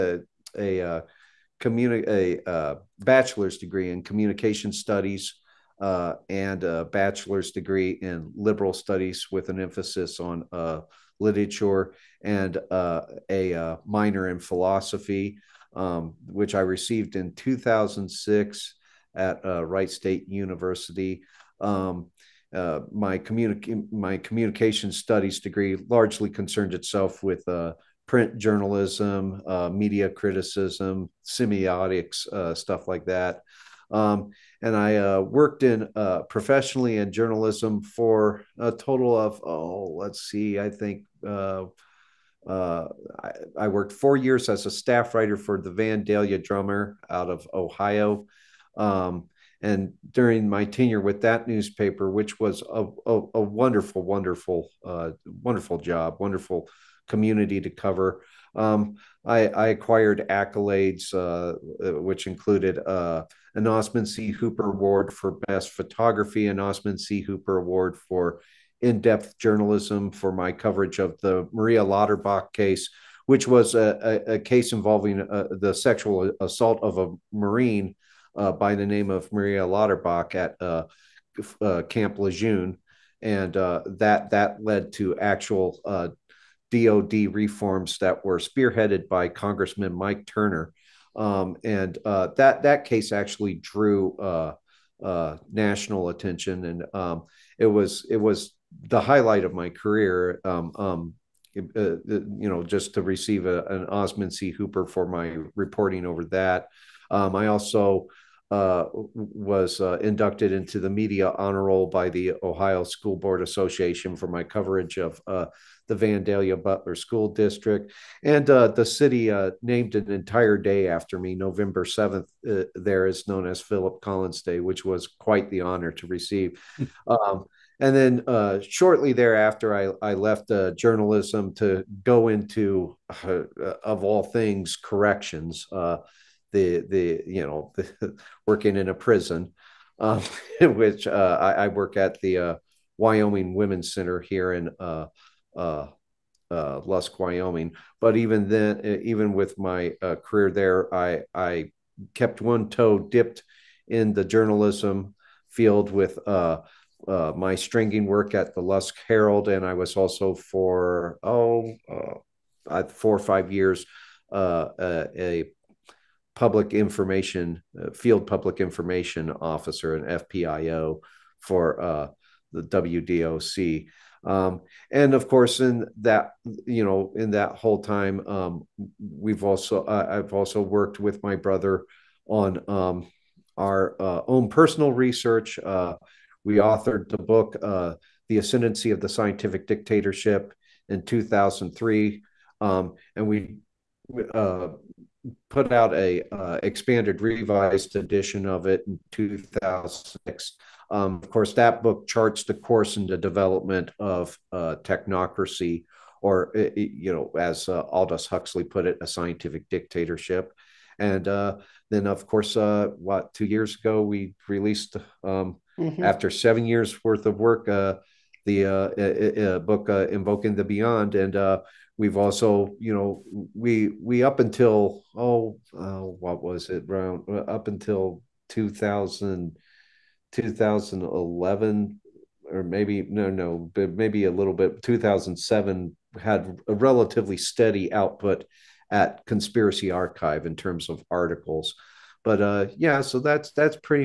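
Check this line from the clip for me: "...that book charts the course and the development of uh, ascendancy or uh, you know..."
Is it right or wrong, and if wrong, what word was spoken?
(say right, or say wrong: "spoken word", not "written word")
wrong: "technocracy", not "ascendancy".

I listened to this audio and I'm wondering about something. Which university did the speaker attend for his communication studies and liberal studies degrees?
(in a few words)
Wright State University.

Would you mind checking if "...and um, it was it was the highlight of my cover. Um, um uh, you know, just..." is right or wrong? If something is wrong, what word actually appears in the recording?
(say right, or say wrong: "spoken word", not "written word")
wrong: "career", not "cover".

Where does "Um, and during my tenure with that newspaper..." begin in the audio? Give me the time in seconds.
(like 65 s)
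48 s.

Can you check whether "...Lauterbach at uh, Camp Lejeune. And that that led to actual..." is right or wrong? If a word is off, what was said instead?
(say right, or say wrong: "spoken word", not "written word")
right.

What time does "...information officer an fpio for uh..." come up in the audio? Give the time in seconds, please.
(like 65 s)
168 s.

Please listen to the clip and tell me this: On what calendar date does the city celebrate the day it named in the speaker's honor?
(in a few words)
November 7th.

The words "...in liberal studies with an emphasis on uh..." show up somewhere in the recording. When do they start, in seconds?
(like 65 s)
7 s.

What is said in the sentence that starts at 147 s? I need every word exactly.
But even then, even with my uh, career there, I I kept one toe dipped in the journalism field with.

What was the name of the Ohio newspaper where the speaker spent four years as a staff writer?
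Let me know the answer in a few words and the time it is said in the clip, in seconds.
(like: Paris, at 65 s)
Vandalia Drummer, at 45 s.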